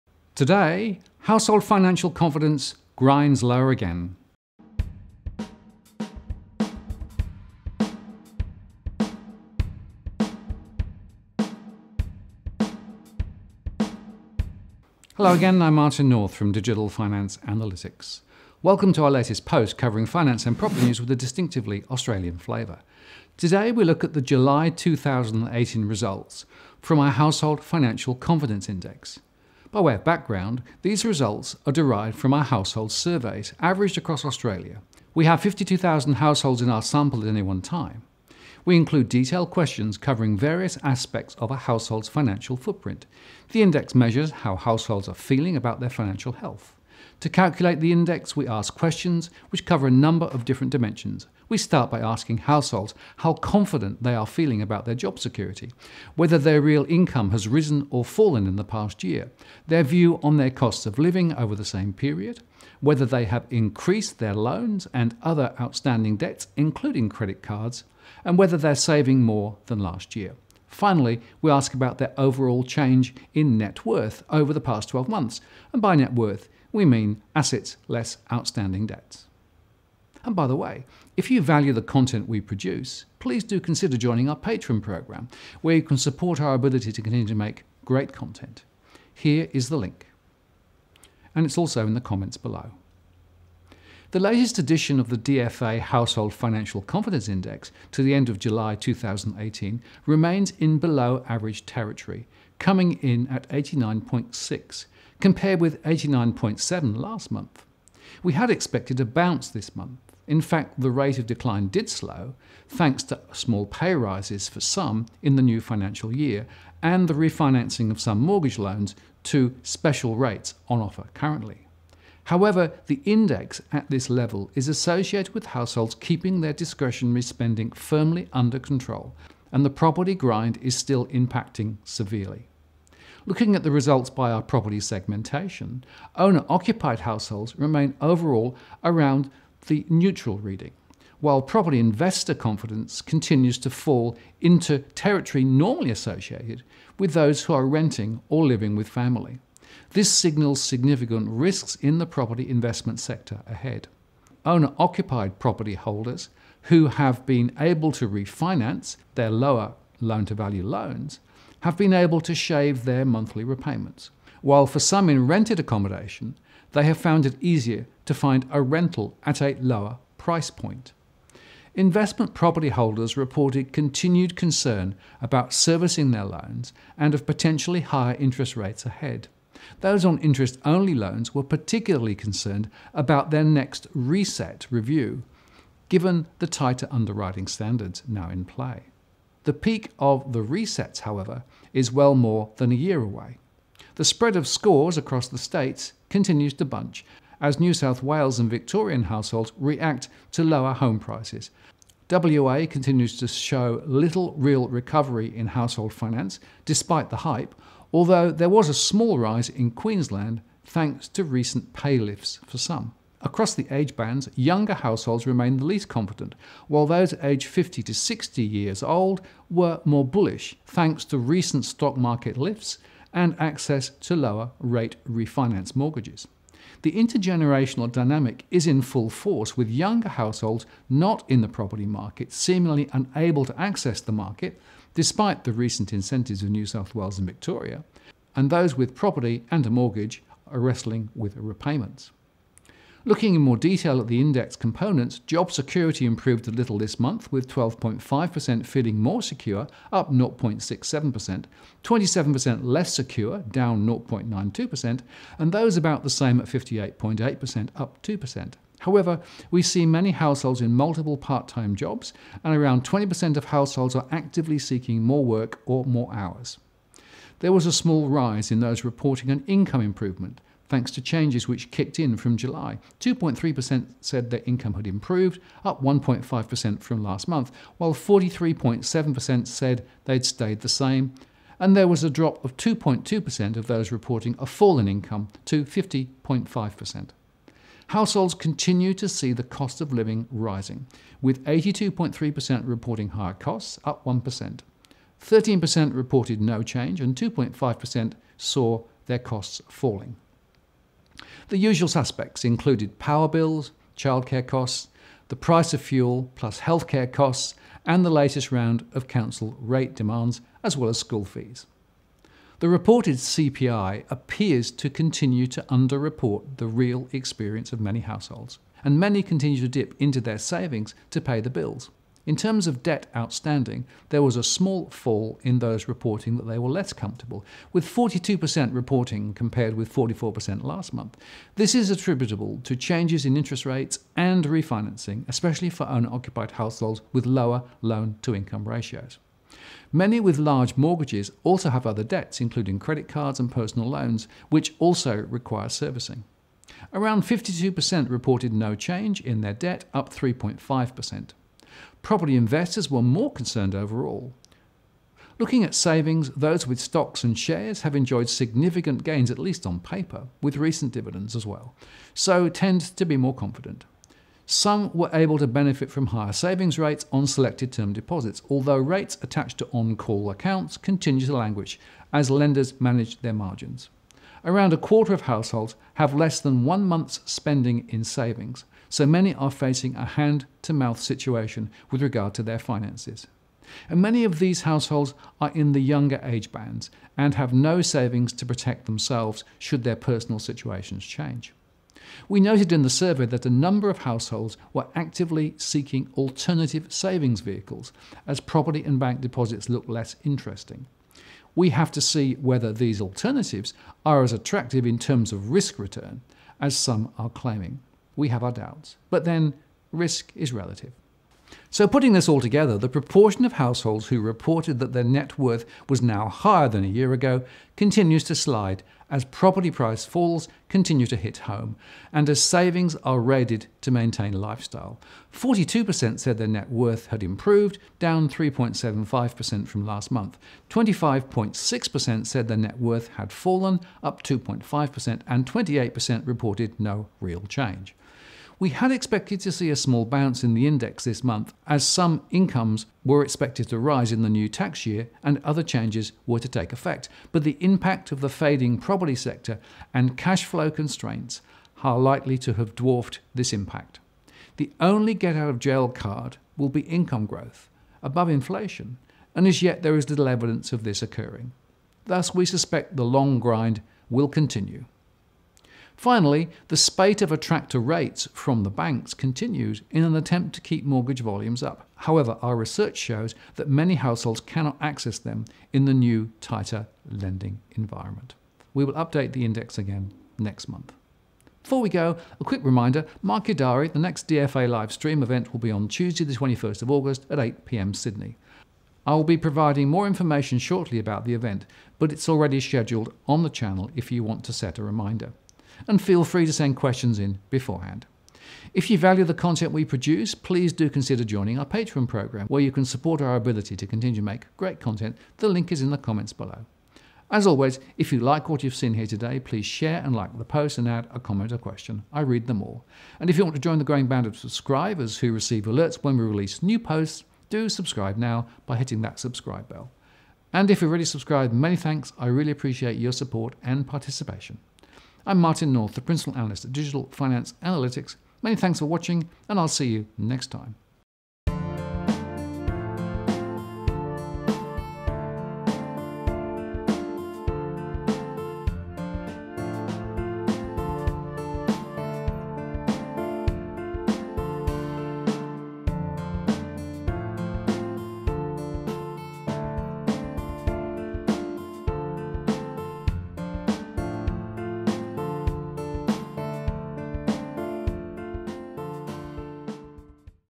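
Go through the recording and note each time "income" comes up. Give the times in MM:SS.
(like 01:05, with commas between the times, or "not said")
00:56, 04:29, 04:34, 04:44, 05:38, 07:22, 07:36.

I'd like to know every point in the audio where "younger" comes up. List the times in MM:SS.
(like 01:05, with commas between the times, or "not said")
03:34, 03:49, 06:25.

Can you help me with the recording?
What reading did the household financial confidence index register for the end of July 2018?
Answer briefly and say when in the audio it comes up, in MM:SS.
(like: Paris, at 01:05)
89.6, at 01:43.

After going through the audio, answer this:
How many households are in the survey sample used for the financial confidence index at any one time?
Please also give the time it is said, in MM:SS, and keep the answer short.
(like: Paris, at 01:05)
52,000, at 00:35.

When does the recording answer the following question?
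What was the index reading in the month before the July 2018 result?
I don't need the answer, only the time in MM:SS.
01:45.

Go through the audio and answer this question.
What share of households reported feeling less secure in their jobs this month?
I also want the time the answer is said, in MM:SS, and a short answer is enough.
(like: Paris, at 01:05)
27%, at 04:11.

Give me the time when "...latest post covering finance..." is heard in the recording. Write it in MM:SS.
00:19.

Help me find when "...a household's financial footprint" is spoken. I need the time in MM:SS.
00:41.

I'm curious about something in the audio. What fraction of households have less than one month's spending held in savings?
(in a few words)
a quarter.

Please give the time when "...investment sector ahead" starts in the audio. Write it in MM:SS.
02:32.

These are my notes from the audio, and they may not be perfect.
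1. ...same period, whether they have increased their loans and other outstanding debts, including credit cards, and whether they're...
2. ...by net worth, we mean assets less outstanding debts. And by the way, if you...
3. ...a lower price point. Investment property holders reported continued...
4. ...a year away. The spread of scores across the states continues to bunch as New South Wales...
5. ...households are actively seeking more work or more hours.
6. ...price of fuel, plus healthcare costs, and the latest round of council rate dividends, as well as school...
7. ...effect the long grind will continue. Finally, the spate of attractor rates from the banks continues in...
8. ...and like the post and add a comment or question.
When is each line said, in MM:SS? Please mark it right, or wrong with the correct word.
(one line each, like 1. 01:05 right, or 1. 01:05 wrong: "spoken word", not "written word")
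1. 01:01 right
2. 01:15 right
3. 02:49 right
4. 03:12 right
5. 04:23 right
6. 05:05 wrong: "demands", not "dividends"
7. 07:42 wrong: "suspect", not "effect"
8. 08:30 right.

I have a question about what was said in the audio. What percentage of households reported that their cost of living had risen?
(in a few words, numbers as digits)
82.3%.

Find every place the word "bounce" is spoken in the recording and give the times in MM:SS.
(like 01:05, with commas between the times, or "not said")
01:49, 07:20.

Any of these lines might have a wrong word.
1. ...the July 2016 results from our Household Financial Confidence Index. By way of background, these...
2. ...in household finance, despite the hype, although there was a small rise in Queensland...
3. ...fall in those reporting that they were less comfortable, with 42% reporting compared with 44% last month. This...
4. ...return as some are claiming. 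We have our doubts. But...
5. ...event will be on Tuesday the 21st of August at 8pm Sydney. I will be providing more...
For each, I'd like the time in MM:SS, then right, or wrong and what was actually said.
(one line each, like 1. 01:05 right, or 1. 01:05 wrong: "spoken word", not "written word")
1. 00:24 wrong: "2018", not "2016"
2. 03:25 right
3. 05:24 right
4. 06:45 right
5. 08:05 right.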